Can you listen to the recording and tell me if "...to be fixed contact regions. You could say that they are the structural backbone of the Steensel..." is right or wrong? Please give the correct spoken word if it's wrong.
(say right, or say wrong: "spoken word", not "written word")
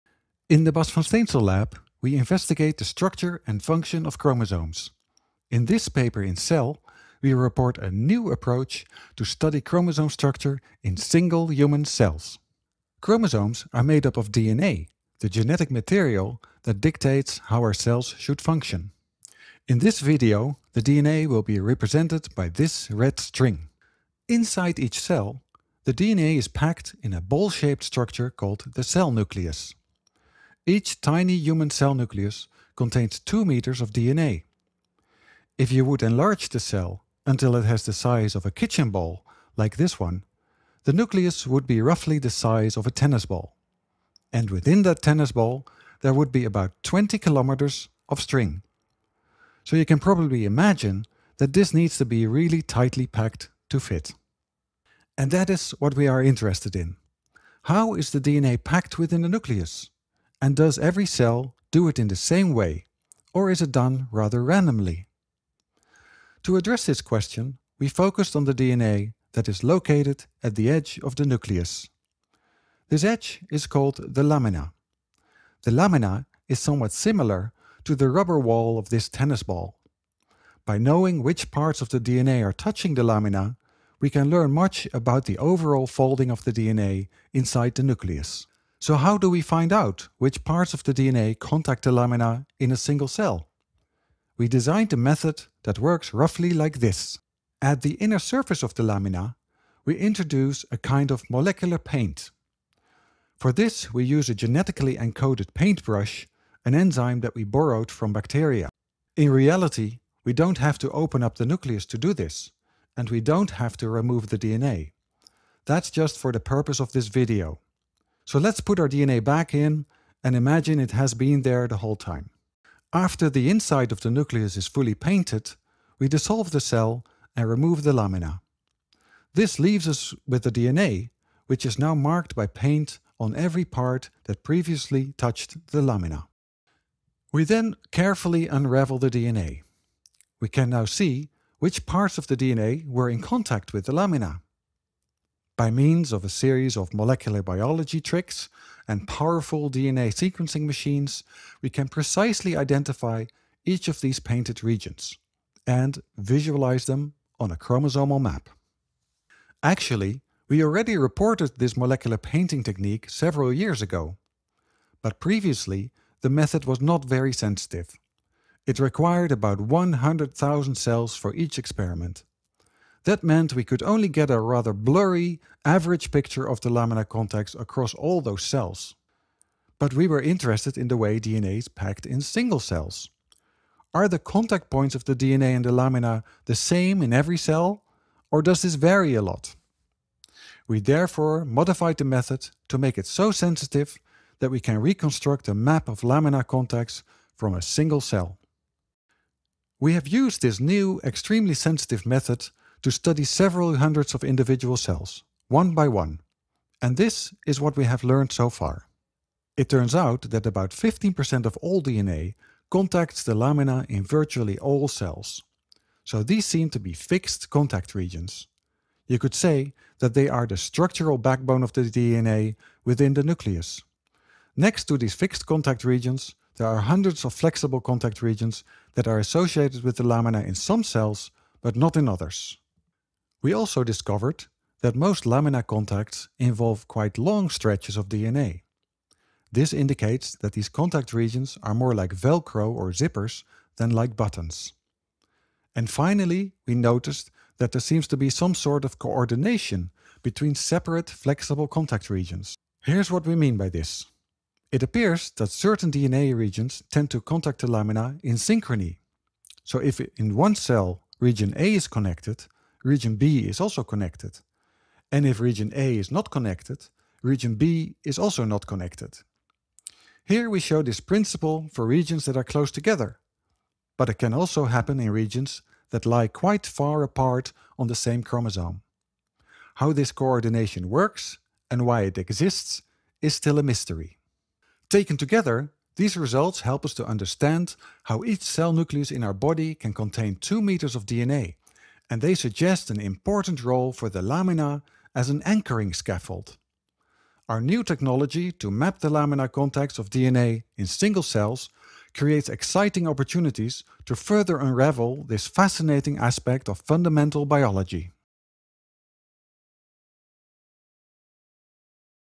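wrong: "DNA", not "Steensel".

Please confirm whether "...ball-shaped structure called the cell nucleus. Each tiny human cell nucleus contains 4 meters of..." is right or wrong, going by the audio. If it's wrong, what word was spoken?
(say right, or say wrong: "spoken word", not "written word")
wrong: "2", not "4".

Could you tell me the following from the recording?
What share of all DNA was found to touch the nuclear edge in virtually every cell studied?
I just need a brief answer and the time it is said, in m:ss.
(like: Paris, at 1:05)
15%, at 3:30.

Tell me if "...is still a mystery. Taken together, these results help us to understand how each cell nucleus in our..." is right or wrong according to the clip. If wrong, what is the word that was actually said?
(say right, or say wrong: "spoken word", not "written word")
right.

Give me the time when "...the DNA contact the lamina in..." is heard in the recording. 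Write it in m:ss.
1:30.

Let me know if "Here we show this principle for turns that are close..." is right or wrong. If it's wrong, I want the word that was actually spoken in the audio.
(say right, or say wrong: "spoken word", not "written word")
wrong: "regions", not "turns".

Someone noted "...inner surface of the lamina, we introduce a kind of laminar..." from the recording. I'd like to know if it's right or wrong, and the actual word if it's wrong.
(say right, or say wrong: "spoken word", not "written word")
wrong: "molecular", not "laminar".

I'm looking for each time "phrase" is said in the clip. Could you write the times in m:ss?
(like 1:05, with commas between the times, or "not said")
not said.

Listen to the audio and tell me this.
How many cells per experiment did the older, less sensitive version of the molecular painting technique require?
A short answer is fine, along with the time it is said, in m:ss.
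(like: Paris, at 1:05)
100,000, at 2:49.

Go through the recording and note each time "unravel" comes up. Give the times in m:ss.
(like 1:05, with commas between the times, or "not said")
2:18, 5:04.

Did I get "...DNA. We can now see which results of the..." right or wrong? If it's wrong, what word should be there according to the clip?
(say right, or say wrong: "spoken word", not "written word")
wrong: "parts", not "results".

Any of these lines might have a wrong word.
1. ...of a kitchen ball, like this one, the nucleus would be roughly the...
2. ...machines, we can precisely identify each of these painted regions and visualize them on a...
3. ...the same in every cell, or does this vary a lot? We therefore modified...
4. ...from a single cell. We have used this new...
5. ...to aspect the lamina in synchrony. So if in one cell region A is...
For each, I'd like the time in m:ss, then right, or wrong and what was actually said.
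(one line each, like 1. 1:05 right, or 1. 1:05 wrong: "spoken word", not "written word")
1. 0:38 right
2. 2:30 right
3. 3:06 right
4. 3:17 right
5. 4:17 wrong: "contact", not "aspect".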